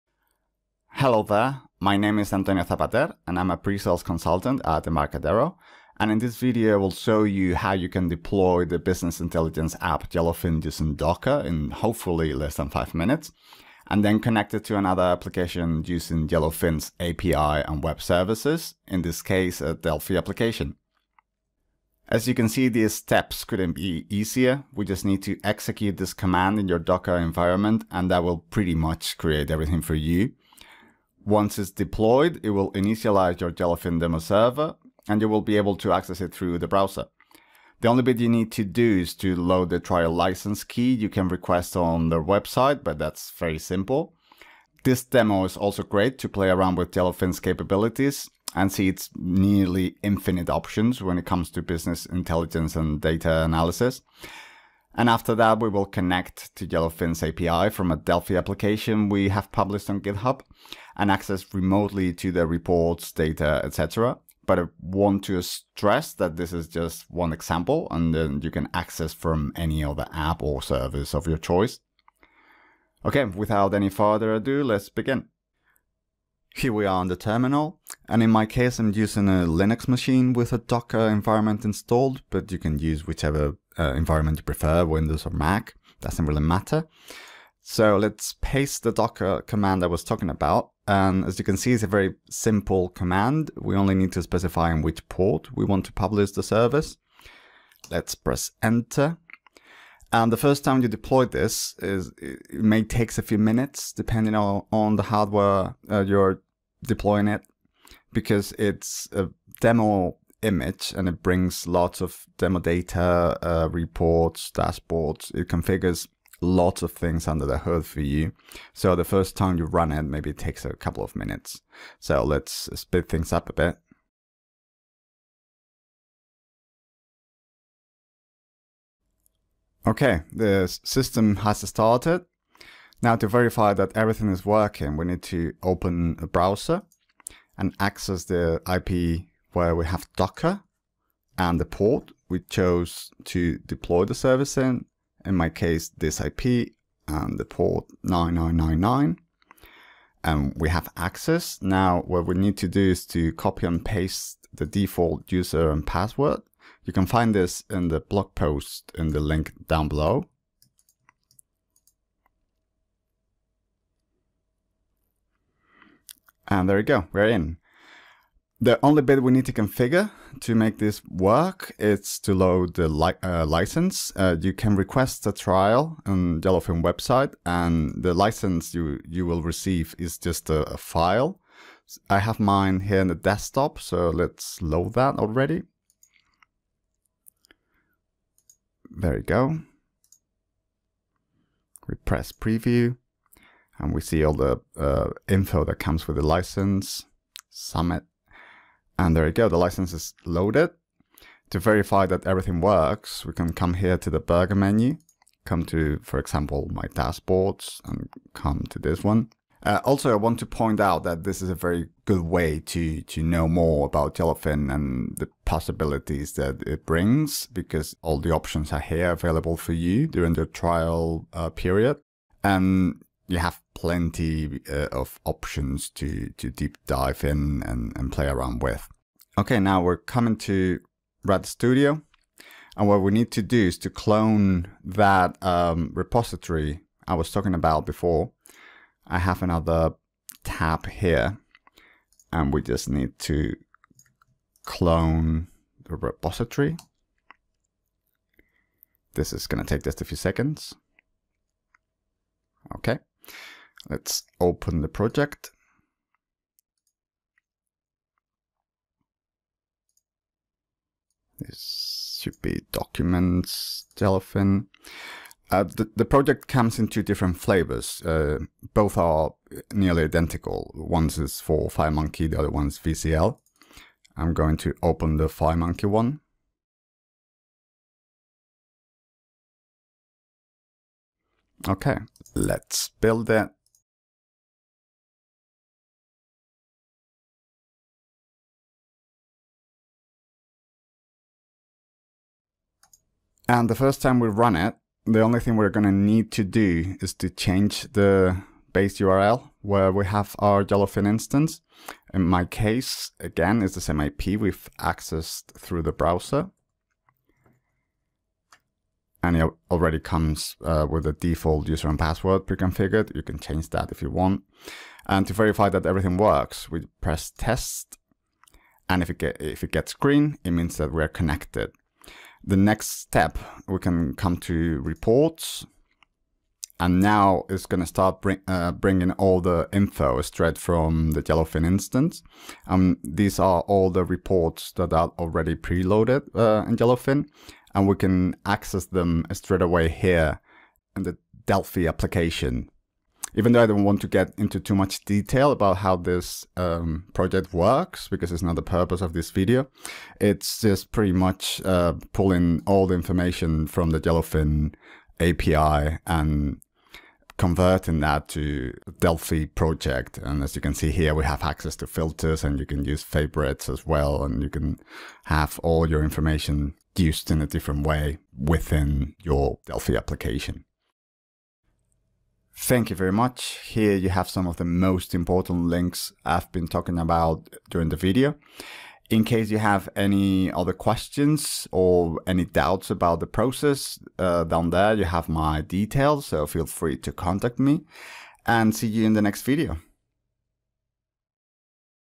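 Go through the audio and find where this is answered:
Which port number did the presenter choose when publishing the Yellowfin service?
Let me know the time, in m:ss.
2:28.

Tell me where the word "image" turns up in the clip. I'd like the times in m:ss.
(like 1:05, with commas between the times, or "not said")
1:50.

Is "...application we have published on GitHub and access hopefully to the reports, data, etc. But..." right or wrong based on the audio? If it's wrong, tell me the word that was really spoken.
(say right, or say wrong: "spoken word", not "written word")
wrong: "remotely", not "hopefully".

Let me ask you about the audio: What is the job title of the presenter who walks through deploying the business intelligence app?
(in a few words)
Pre-sales consultant.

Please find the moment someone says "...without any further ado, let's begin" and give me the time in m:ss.
1:13.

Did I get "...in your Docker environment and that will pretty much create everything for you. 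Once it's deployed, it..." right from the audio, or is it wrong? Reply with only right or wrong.
right.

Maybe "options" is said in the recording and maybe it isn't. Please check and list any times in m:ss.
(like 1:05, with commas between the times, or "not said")
0:50, 3:38, 3:45.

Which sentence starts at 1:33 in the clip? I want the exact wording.
We only need to specify in which port we want to publish the service.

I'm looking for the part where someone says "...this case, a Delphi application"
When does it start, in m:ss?
0:19.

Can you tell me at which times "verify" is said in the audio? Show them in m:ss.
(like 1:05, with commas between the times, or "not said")
2:13, 3:21, 5:15.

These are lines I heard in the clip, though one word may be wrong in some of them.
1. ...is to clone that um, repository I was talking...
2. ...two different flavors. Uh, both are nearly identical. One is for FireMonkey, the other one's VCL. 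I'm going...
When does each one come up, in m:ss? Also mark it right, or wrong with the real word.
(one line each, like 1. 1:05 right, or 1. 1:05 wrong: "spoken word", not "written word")
1. 3:53 right
2. 4:26 right.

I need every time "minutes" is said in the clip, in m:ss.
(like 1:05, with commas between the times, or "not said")
0:12, 1:43, 2:01.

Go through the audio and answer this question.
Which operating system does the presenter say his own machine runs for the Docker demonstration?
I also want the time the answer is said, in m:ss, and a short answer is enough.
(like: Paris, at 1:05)
Linux, at 1:19.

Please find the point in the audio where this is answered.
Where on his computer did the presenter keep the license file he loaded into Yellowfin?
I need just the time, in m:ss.
3:03.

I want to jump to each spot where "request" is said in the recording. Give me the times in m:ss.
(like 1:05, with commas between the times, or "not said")
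0:41, 2:54.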